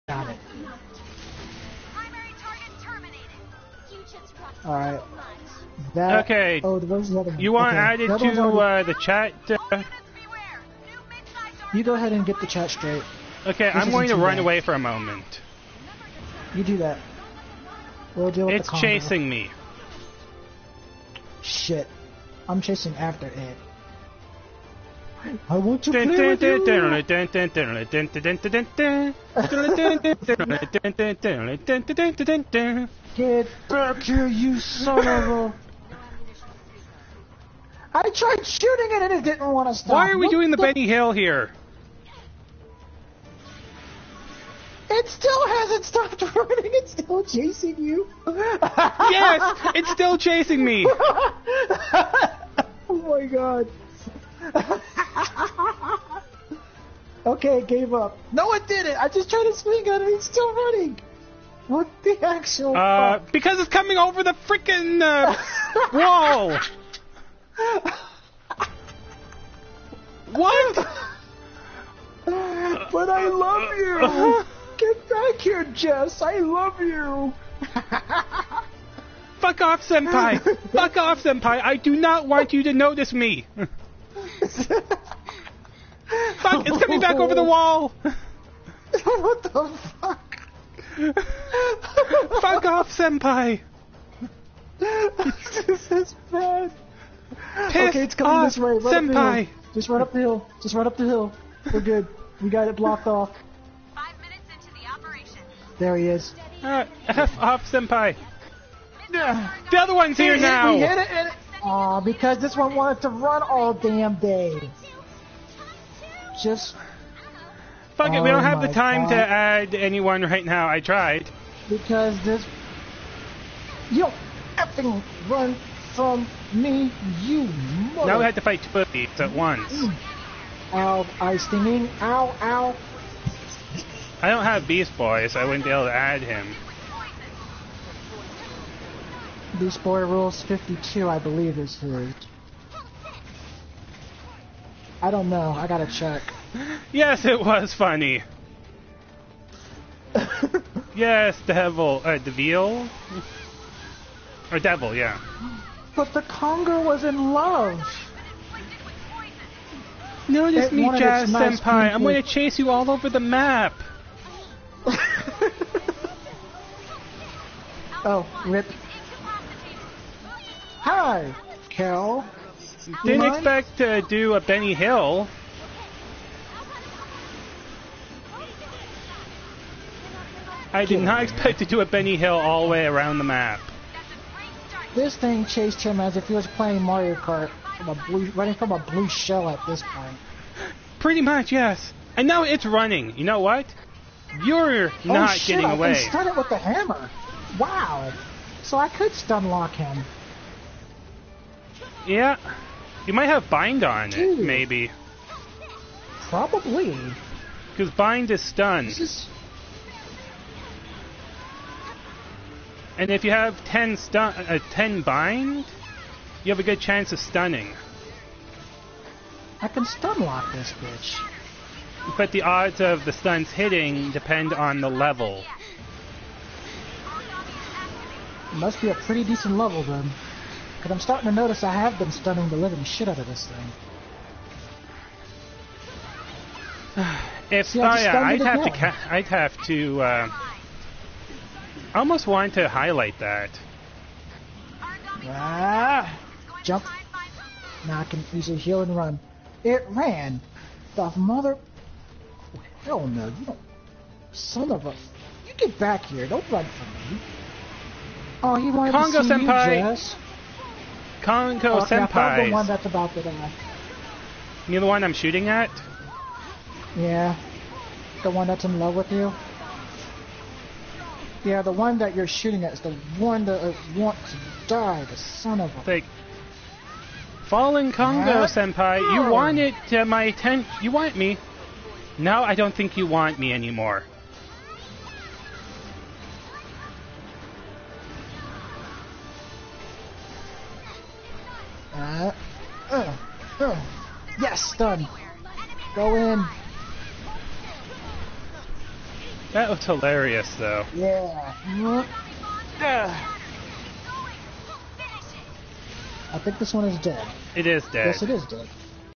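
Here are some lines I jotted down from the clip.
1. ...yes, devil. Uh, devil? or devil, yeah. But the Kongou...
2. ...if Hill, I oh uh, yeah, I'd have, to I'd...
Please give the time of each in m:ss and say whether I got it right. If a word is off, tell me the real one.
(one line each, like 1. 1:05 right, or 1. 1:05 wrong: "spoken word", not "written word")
1. 2:30 right
2. 3:57 wrong: "See", not "Hill".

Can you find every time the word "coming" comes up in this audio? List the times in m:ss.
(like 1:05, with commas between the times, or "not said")
1:03, 1:26, 1:38.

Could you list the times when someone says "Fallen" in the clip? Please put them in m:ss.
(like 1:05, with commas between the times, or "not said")
4:37.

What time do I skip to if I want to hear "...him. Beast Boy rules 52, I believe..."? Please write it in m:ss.
2:16.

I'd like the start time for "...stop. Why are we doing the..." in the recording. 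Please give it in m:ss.
0:39.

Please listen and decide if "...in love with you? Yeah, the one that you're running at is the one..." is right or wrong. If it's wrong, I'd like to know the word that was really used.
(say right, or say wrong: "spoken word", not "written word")
wrong: "shooting", not "running".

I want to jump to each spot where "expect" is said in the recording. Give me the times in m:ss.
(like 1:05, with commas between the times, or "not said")
2:53, 3:01.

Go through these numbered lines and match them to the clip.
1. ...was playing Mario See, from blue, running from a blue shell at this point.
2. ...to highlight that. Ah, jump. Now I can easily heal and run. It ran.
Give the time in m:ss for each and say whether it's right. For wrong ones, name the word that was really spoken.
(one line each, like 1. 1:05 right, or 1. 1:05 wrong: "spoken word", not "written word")
1. 3:06 wrong: "Kart", not "See"
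2. 4:02 right.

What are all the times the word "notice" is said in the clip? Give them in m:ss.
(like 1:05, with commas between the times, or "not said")
1:22, 3:51.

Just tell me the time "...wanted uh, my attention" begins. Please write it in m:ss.
4:39.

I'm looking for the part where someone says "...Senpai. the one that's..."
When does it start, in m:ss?
4:21.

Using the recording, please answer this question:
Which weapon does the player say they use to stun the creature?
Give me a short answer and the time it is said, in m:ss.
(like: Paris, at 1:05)
hammer, at 3:16.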